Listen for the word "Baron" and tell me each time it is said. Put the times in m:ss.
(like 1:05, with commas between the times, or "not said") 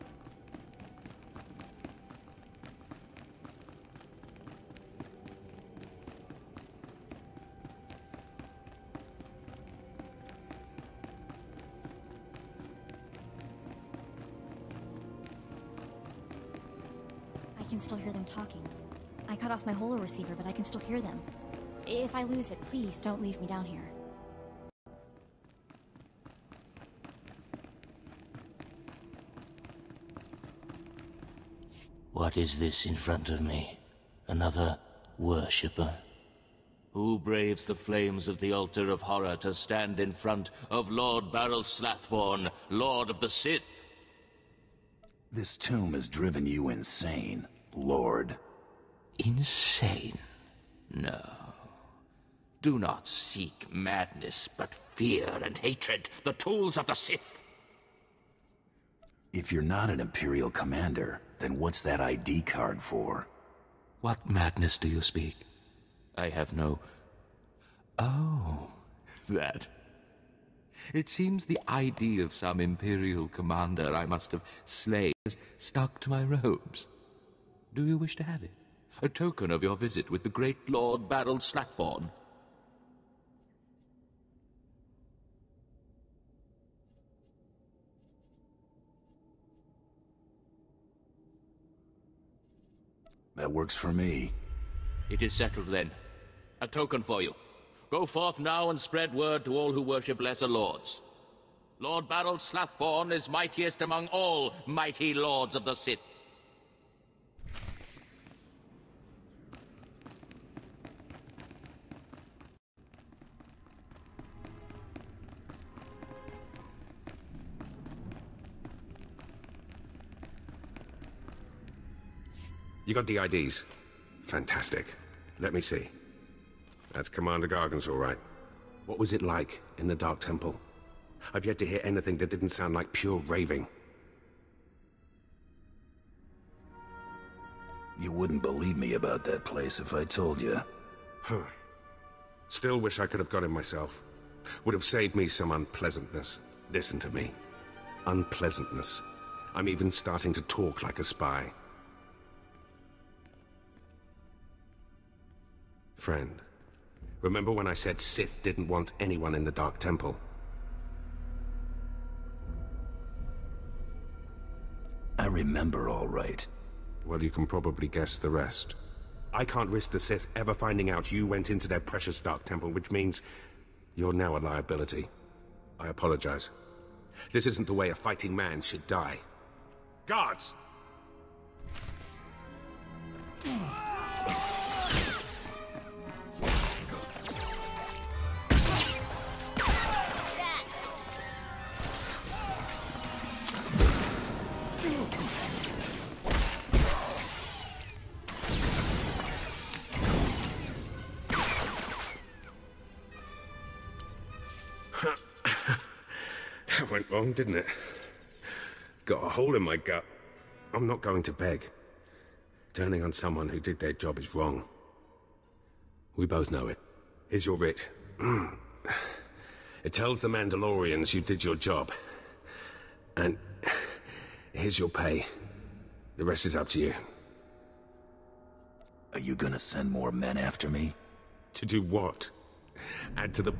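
1:21.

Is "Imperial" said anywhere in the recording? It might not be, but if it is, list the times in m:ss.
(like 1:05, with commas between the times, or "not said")
1:00, 1:12.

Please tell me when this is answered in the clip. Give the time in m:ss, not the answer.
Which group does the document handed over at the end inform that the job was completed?
3:40.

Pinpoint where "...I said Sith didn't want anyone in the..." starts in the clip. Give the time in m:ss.
2:37.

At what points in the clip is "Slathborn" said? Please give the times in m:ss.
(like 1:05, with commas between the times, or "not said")
0:41, 1:42.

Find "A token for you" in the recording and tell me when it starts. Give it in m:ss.
1:36.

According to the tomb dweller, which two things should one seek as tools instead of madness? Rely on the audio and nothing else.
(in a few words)
Fear and hatred.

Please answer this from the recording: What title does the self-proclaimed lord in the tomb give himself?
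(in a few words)
Lord of the Sith.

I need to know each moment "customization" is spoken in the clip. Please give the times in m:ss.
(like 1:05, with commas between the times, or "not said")
not said.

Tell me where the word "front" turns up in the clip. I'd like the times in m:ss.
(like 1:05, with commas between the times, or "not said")
0:32, 0:40.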